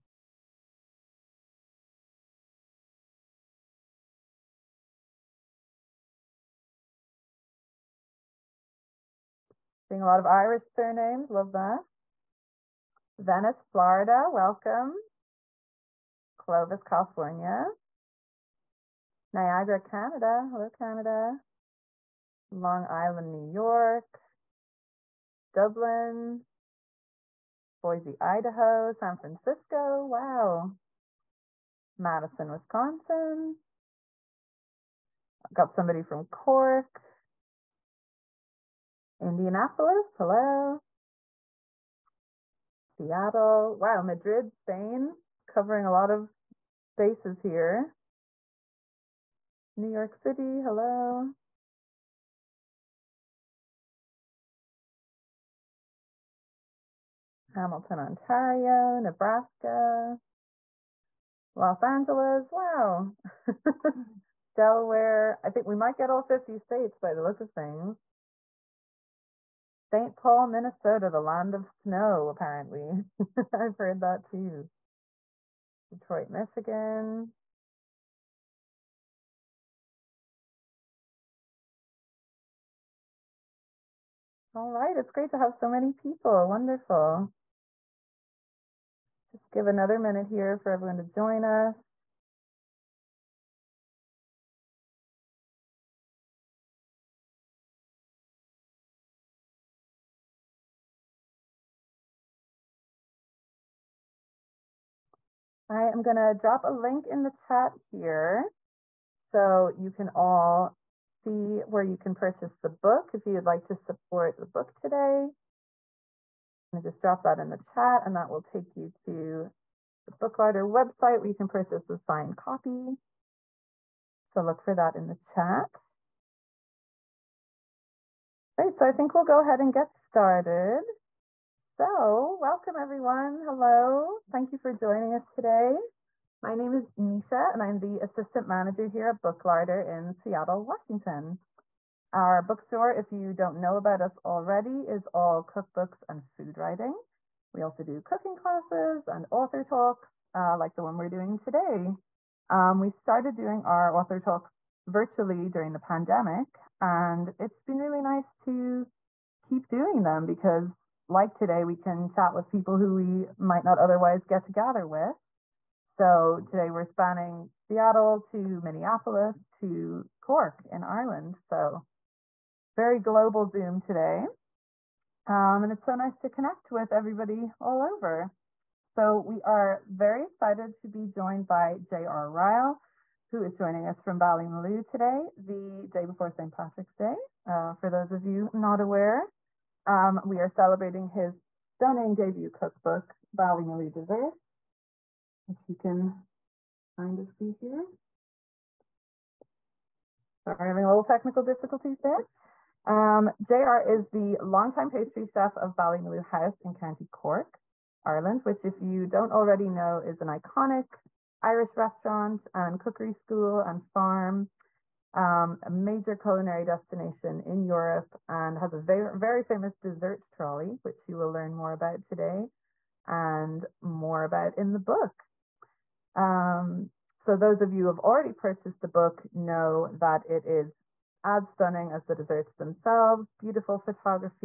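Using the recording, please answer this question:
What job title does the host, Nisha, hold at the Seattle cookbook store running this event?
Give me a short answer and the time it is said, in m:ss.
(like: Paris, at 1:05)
Assistant manager, at 2:18.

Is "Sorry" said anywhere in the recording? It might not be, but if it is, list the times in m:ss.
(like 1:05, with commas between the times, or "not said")
3:20.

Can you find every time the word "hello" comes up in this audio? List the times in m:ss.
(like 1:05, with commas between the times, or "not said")
0:20, 0:40, 0:50, 2:13.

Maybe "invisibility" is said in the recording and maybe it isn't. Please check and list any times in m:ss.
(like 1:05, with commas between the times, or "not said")
not said.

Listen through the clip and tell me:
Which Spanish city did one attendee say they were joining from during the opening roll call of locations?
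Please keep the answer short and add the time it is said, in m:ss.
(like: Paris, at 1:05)
Madrid, at 0:44.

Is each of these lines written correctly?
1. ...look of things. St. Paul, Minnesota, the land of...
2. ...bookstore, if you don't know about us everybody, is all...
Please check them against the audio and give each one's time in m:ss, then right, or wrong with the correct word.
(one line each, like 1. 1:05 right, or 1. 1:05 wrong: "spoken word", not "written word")
1. 1:07 right
2. 2:22 wrong: "already", not "everybody".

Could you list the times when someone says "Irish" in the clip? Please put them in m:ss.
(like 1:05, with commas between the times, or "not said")
0:10, 3:31.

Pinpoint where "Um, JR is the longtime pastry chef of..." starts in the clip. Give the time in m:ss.
3:22.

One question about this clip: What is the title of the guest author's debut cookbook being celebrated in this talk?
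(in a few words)
Ballymaloe Desserts.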